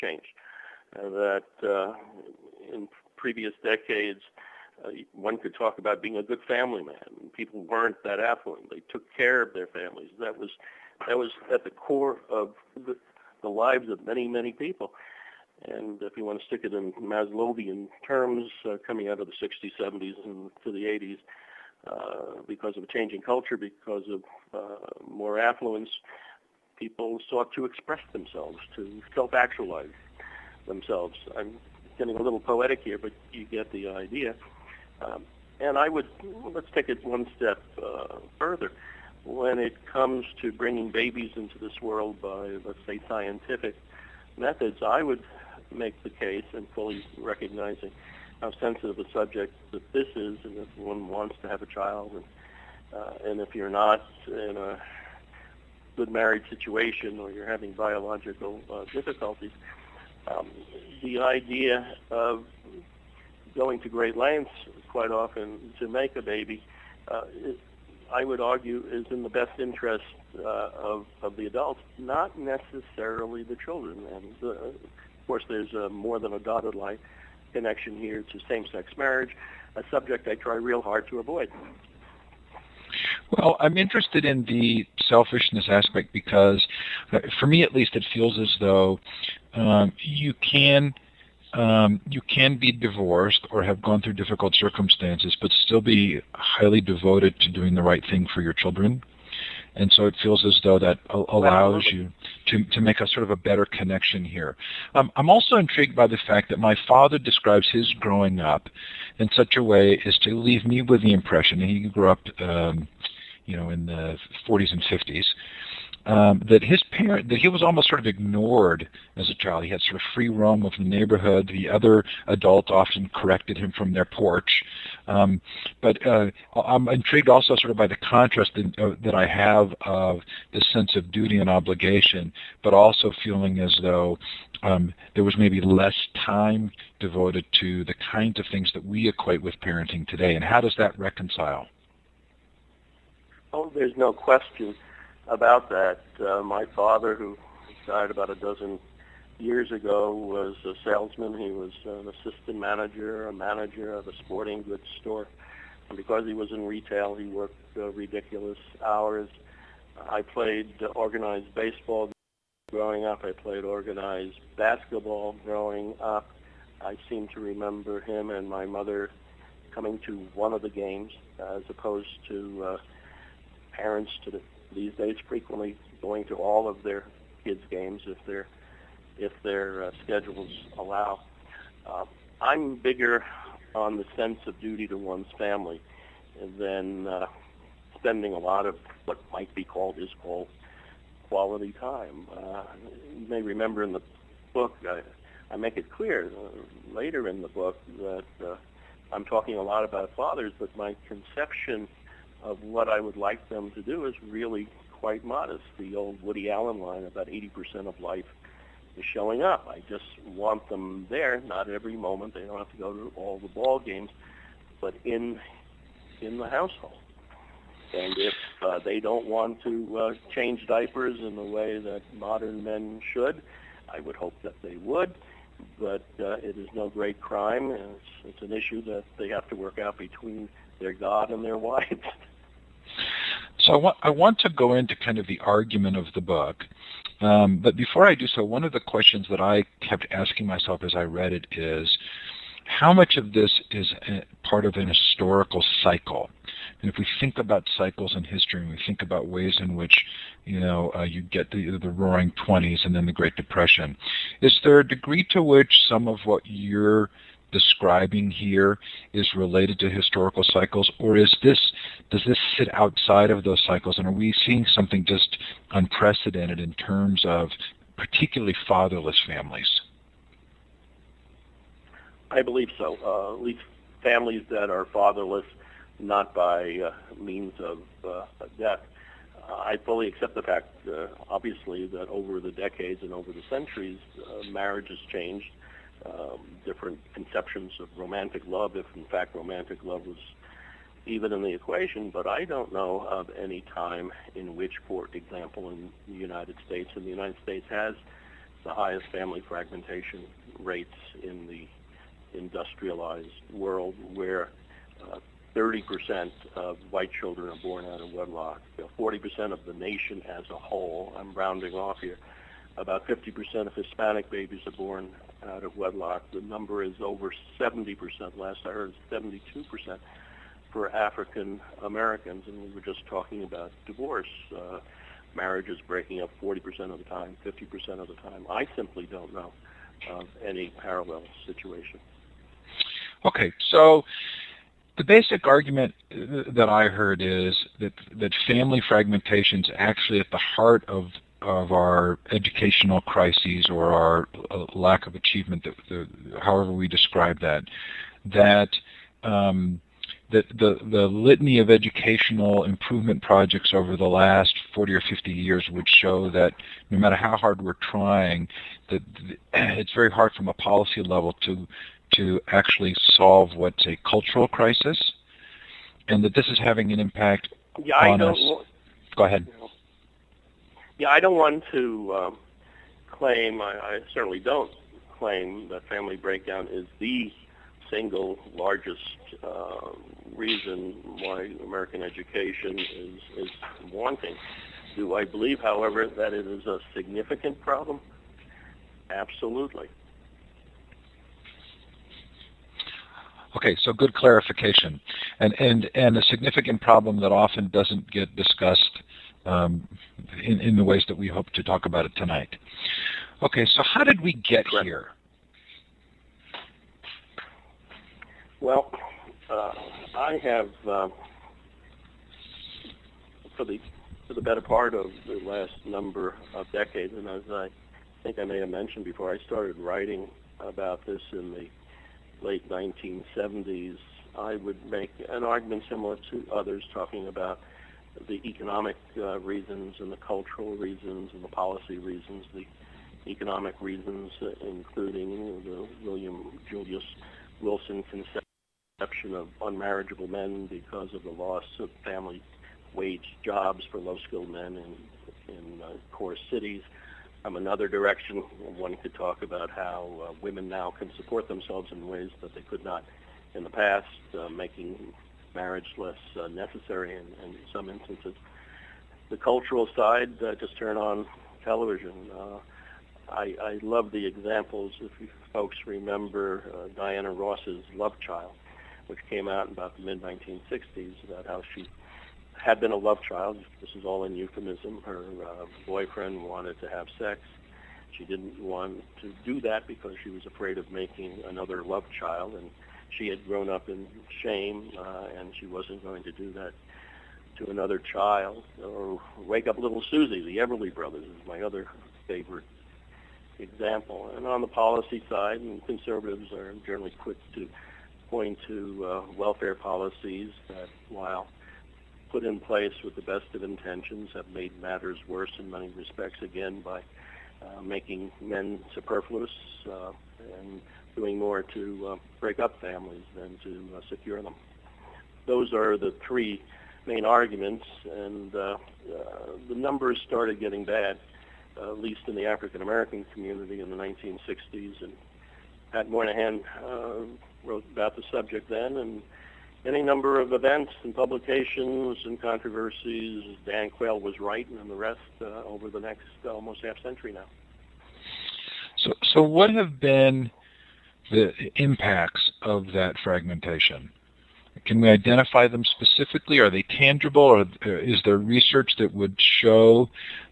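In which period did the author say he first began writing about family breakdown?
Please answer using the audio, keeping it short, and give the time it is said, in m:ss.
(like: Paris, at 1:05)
late 1970s, at 7:02.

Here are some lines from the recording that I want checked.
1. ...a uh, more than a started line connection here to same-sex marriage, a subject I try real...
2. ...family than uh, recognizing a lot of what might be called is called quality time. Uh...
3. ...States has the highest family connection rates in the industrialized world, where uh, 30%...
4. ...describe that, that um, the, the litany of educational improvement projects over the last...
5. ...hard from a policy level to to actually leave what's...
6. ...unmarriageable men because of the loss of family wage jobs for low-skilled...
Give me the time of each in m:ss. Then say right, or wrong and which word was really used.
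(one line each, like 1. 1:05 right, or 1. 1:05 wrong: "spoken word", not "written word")
1. 1:15 wrong: "dotted", not "started"
2. 3:05 wrong: "spending", not "recognizing"
3. 4:57 wrong: "fragmentation", not "connection"
4. 5:46 right
5. 6:00 wrong: "solve", not "leave"
6. 7:19 right.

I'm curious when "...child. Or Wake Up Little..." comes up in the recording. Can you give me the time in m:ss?
8:07.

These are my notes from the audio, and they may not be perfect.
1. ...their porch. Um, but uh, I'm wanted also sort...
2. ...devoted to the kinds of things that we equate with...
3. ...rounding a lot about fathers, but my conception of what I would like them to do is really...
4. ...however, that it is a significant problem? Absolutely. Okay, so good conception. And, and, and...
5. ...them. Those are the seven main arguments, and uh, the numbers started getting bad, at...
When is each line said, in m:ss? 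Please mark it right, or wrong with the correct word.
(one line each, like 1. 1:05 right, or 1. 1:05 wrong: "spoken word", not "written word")
1. 2:03 wrong: "intrigued", not "wanted"
2. 2:16 right
3. 3:19 wrong: "talking", not "rounding"
4. 6:25 wrong: "clarification", not "conception"
5. 8:34 wrong: "three", not "seven".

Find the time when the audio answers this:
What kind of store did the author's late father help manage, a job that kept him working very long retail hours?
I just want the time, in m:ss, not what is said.
2:34.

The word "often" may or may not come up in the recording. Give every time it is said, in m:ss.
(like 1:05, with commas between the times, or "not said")
1:05, 2:02, 6:37.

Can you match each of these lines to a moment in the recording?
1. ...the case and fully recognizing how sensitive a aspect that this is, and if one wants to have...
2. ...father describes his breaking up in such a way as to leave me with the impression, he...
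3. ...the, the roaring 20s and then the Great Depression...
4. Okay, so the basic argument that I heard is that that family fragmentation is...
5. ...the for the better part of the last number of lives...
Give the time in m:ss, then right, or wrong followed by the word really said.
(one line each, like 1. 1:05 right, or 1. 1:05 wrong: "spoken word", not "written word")
1. 0:46 wrong: "subject", not "aspect"
2. 1:46 wrong: "growing", not "breaking"
3. 4:11 right
4. 5:33 right
5. 6:53 wrong: "decades", not "lives".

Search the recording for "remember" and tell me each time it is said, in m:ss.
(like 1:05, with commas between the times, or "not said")
2:47, 3:13, 7:45.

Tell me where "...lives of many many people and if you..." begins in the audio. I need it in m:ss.
0:13.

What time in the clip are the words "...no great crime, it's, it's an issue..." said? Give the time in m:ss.
3:46.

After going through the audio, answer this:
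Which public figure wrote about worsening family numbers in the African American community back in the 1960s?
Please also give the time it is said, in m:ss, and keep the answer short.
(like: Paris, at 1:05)
Pat Moynihan, at 8:45.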